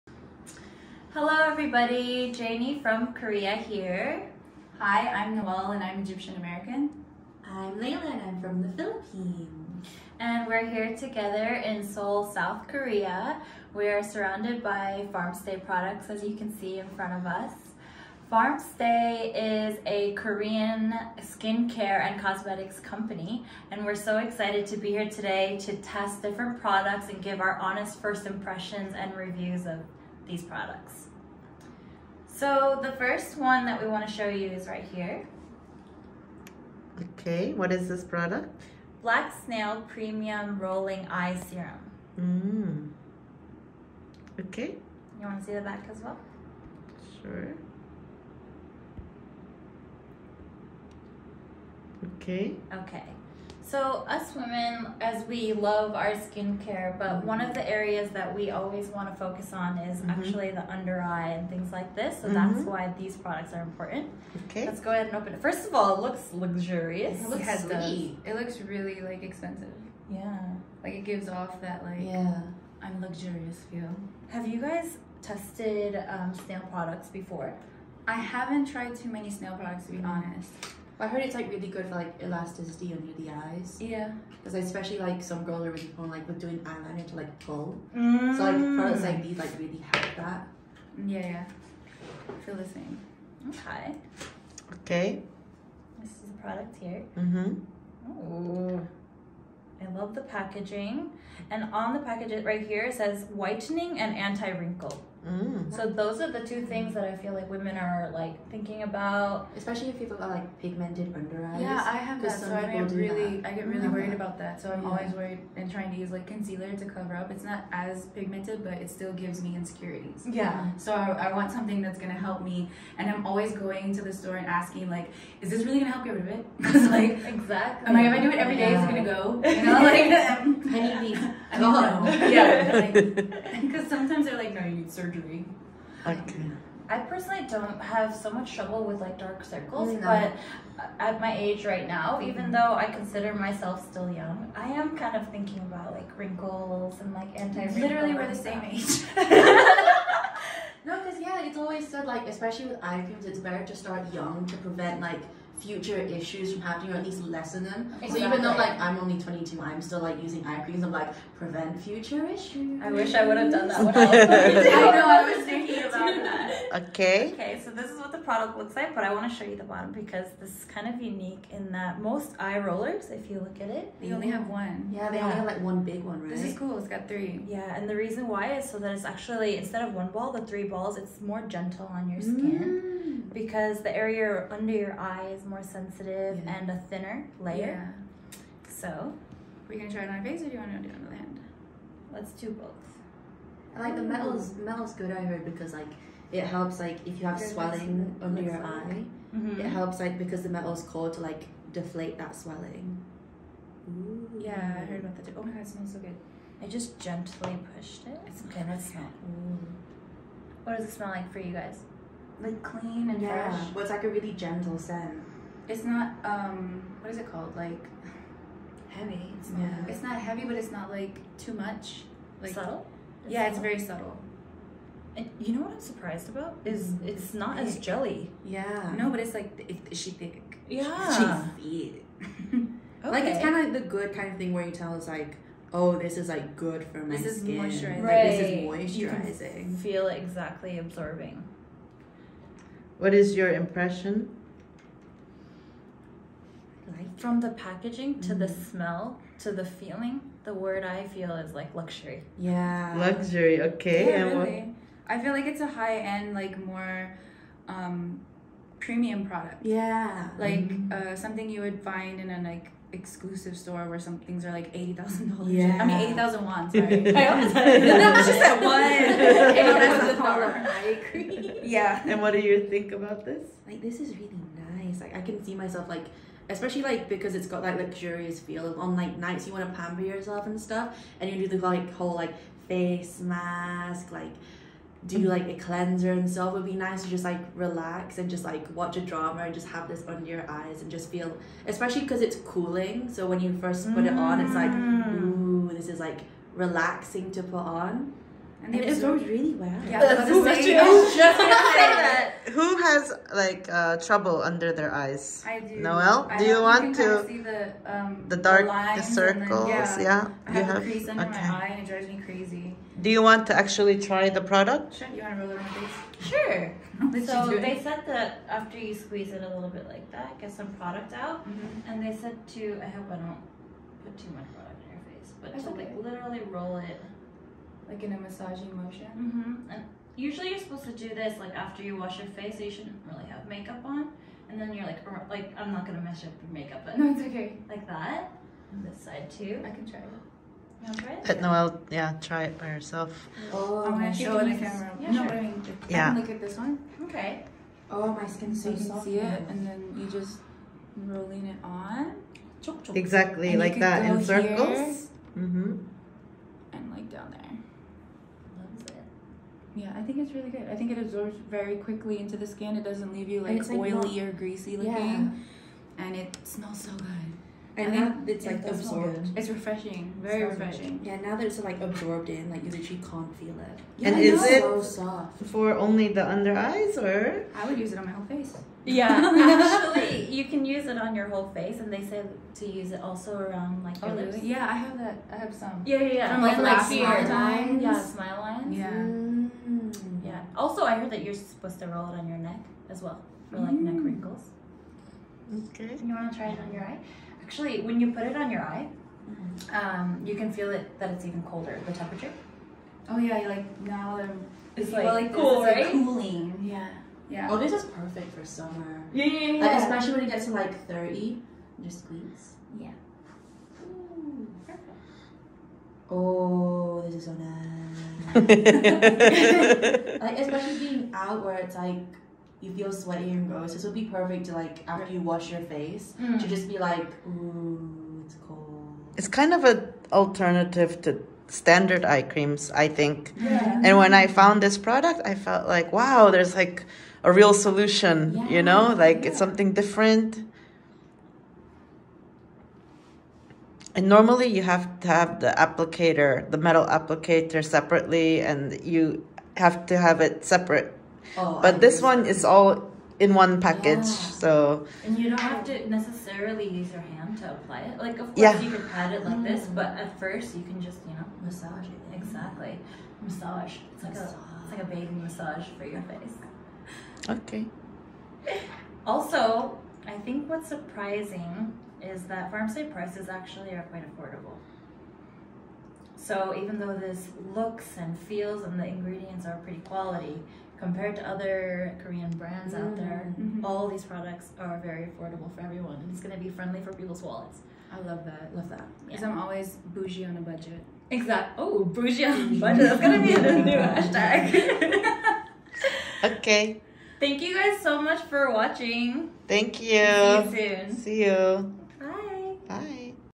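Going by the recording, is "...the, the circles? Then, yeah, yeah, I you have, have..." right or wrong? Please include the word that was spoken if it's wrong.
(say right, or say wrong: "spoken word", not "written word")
right.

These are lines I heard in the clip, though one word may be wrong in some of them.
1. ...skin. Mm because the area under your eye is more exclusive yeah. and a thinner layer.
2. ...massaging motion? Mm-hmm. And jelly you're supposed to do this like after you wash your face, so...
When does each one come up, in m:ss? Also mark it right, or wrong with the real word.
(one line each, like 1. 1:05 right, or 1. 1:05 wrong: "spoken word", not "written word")
1. 3:02 wrong: "sensitive", not "exclusive"
2. 5:28 wrong: "usually", not "jelly".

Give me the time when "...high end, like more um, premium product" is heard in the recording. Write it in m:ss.
4:15.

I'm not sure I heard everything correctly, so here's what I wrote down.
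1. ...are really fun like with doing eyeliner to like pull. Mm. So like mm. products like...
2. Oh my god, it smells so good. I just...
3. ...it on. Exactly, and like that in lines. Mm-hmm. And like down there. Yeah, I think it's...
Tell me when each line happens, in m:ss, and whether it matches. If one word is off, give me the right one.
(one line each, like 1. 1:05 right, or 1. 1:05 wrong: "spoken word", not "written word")
1. 1:25 right
2. 3:25 right
3. 5:51 wrong: "circles", not "lines".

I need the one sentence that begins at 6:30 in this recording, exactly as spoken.
Also, I heard that you're supposed to roll it on your neck as well for like mm.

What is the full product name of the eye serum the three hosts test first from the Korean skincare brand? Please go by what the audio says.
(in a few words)
Black Snail Premium Rolling Eye Serum.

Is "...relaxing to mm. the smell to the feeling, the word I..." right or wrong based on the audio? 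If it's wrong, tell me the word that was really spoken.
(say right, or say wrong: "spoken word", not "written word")
wrong: "packaging", not "relaxing".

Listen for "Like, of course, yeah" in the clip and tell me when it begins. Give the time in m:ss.
7:37.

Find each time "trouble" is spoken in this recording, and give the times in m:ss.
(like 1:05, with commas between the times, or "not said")
2:18, 5:03.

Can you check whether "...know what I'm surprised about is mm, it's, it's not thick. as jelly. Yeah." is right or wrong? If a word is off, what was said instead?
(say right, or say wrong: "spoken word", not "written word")
right.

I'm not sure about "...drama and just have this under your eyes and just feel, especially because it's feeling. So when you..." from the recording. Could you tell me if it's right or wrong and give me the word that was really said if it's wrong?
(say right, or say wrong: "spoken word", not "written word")
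wrong: "cooling", not "feeling".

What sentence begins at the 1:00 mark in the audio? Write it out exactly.
actually the under eye and things like this.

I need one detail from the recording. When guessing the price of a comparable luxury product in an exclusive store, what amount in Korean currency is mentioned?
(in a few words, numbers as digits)
80,000 won.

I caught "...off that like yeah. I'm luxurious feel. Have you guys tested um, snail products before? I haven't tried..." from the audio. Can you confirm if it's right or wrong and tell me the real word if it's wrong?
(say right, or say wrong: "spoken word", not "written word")
right.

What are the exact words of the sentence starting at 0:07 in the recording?
I'm Layla and I'm from the Philippines.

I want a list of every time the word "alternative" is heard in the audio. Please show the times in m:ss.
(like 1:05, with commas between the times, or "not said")
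7:10.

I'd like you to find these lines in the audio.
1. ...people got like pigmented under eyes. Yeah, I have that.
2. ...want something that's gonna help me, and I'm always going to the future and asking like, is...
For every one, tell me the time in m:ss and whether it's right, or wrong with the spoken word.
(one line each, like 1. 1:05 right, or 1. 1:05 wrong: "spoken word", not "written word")
1. 1:49 right
2. 2:01 wrong: "store", not "future".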